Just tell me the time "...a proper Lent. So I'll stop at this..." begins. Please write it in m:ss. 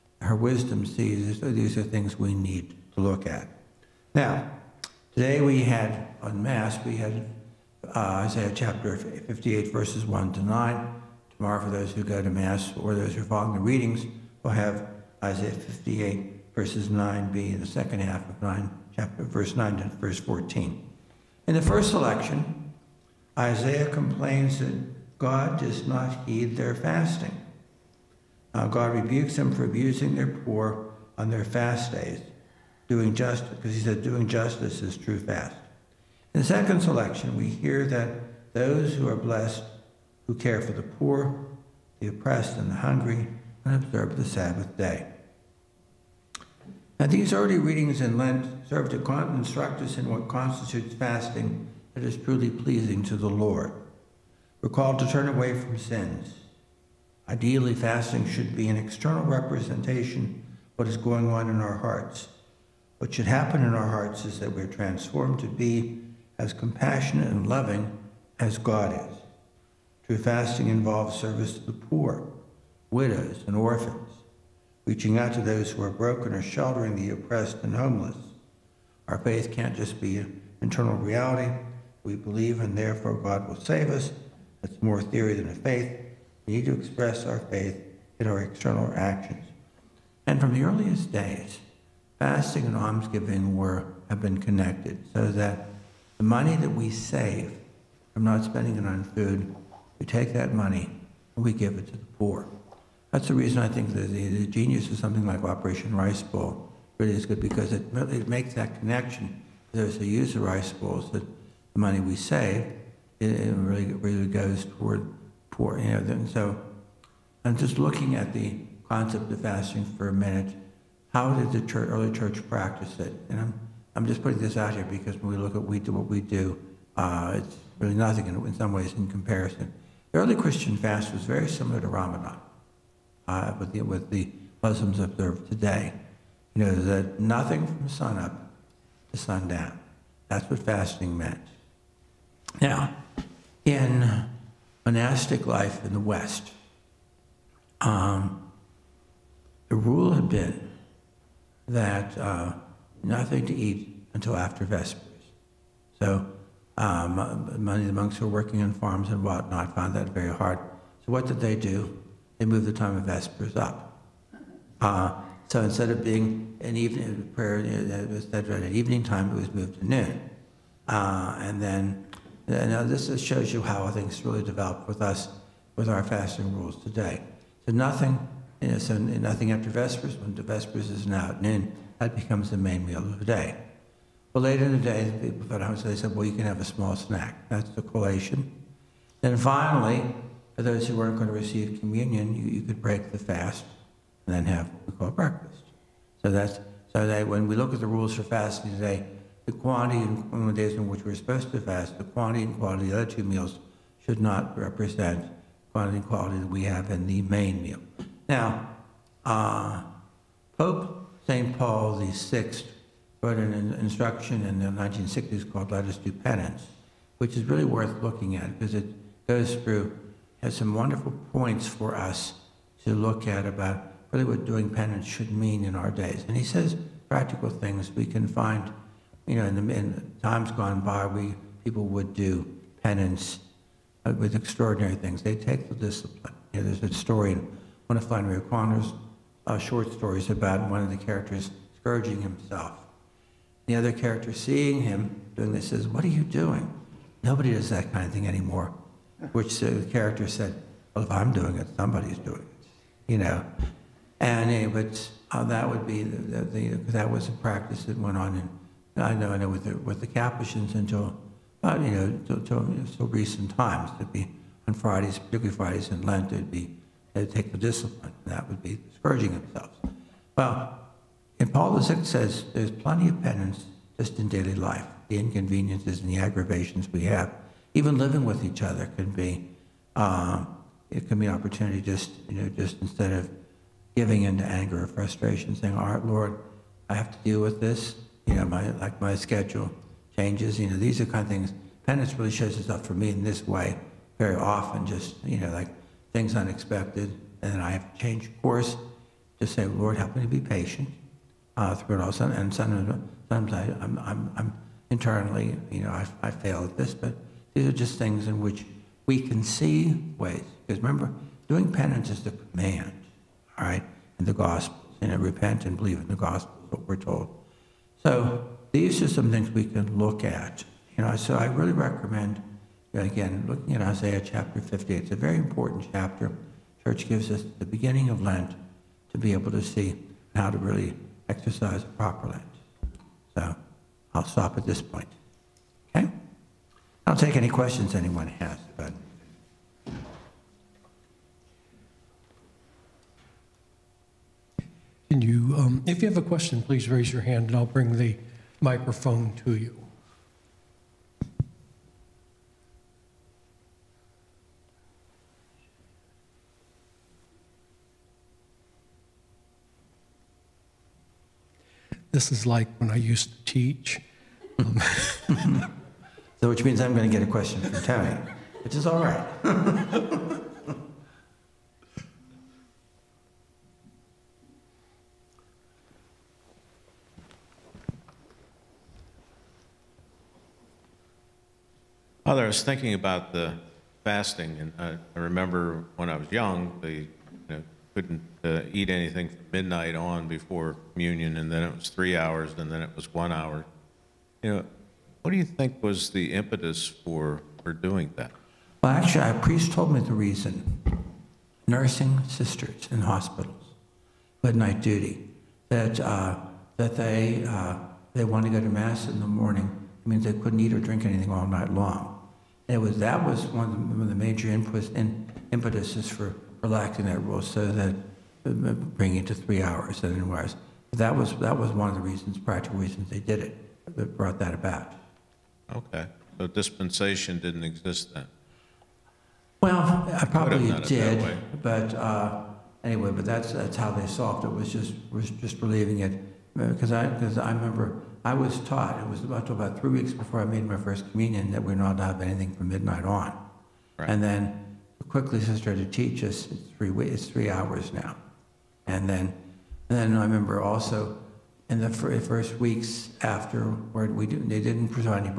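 5:31.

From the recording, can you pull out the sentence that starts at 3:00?
When Vespers is now at noon, that becomes the main meal of the day.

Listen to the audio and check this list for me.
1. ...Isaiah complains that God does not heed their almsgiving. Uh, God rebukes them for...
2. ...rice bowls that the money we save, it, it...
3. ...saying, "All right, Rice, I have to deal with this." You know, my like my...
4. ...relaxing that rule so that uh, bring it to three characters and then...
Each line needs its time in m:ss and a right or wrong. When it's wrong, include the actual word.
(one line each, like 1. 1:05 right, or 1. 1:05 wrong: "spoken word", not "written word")
1. 0:23 wrong: "fasting", not "almsgiving"
2. 1:50 right
3. 4:45 wrong: "Lord", not "Rice"
4. 6:56 wrong: "hours", not "characters".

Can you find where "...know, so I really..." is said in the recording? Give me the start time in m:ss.
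5:21.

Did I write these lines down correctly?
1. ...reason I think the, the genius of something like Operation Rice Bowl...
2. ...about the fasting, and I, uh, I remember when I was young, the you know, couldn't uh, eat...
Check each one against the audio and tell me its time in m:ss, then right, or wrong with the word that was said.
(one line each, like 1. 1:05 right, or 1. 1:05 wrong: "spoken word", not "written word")
1. 1:43 right
2. 6:22 right.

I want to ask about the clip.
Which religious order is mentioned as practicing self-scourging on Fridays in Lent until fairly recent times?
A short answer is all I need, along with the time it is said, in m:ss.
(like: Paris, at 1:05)
Capuchins, at 4:20.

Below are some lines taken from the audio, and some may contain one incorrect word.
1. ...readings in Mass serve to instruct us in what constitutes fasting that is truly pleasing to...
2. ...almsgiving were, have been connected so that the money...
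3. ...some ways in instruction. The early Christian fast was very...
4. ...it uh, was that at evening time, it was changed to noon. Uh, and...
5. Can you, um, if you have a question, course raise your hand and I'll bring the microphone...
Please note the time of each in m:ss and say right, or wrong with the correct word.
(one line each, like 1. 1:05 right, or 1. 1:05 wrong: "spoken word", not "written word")
1. 0:47 wrong: "Lent", not "Mass"
2. 1:32 right
3. 2:08 wrong: "comparison", not "instruction"
4. 2:47 wrong: "moved", not "changed"
5. 5:45 wrong: "please", not "course".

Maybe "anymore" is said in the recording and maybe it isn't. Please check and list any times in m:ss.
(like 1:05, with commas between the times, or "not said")
4:08.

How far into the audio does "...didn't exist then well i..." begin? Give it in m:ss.
7:07.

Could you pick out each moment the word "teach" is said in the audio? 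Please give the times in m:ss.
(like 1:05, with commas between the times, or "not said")
6:03, 7:25.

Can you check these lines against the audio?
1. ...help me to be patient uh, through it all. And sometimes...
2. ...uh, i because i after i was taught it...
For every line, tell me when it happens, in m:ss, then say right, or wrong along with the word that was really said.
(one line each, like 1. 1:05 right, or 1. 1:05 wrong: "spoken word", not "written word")
1. 4:59 right
2. 7:16 wrong: "remember", not "after".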